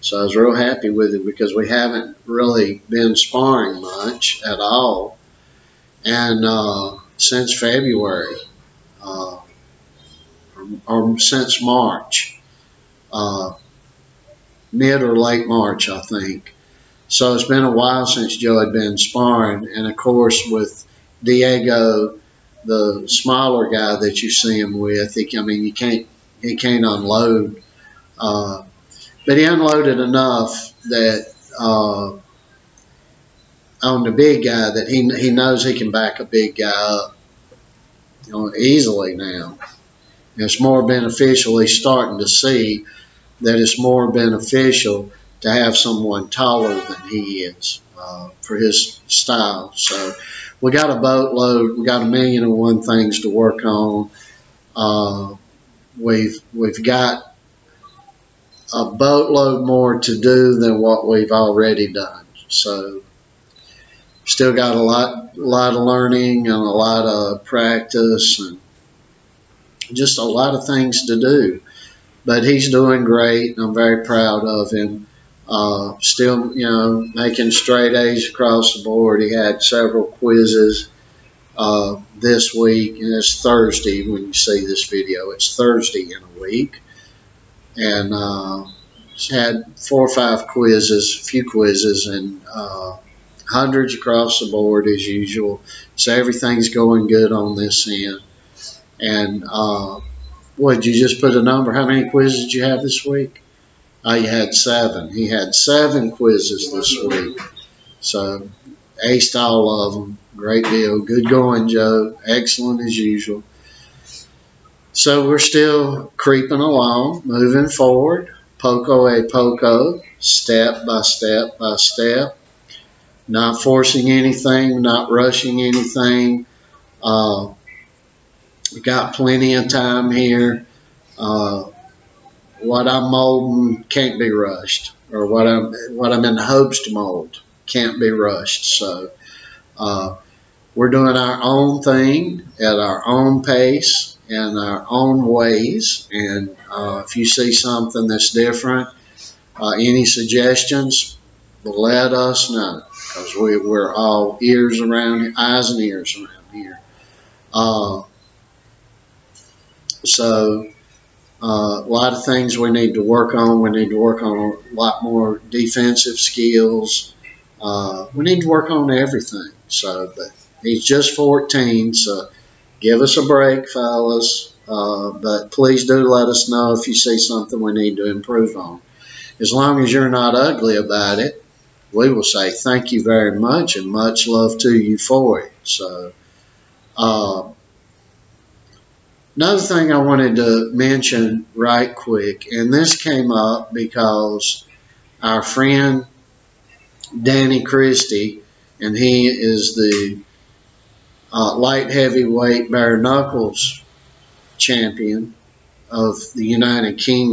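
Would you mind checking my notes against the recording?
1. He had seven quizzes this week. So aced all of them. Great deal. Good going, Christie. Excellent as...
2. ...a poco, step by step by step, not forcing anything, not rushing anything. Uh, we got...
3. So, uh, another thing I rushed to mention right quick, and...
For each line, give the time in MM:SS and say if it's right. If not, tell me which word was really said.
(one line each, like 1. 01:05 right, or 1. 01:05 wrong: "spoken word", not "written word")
1. 01:45 wrong: "Joe", not "Christie"
2. 01:59 right
3. 03:05 wrong: "wanted", not "rushed".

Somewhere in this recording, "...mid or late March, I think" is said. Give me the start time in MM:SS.
00:14.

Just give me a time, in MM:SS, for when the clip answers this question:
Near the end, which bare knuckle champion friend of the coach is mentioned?
03:17.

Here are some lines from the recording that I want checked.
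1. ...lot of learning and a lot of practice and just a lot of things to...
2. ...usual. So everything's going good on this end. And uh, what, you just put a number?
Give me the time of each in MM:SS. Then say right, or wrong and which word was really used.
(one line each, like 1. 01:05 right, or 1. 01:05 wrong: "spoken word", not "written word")
1. 01:05 right
2. 01:35 right.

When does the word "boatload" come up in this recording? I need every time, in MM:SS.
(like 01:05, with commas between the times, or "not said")
00:50, 00:58.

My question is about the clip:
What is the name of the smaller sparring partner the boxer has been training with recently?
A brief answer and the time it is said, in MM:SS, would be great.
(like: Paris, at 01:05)
Diego, at 00:21.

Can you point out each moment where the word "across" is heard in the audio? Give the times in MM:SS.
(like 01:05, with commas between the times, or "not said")
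01:18, 01:33.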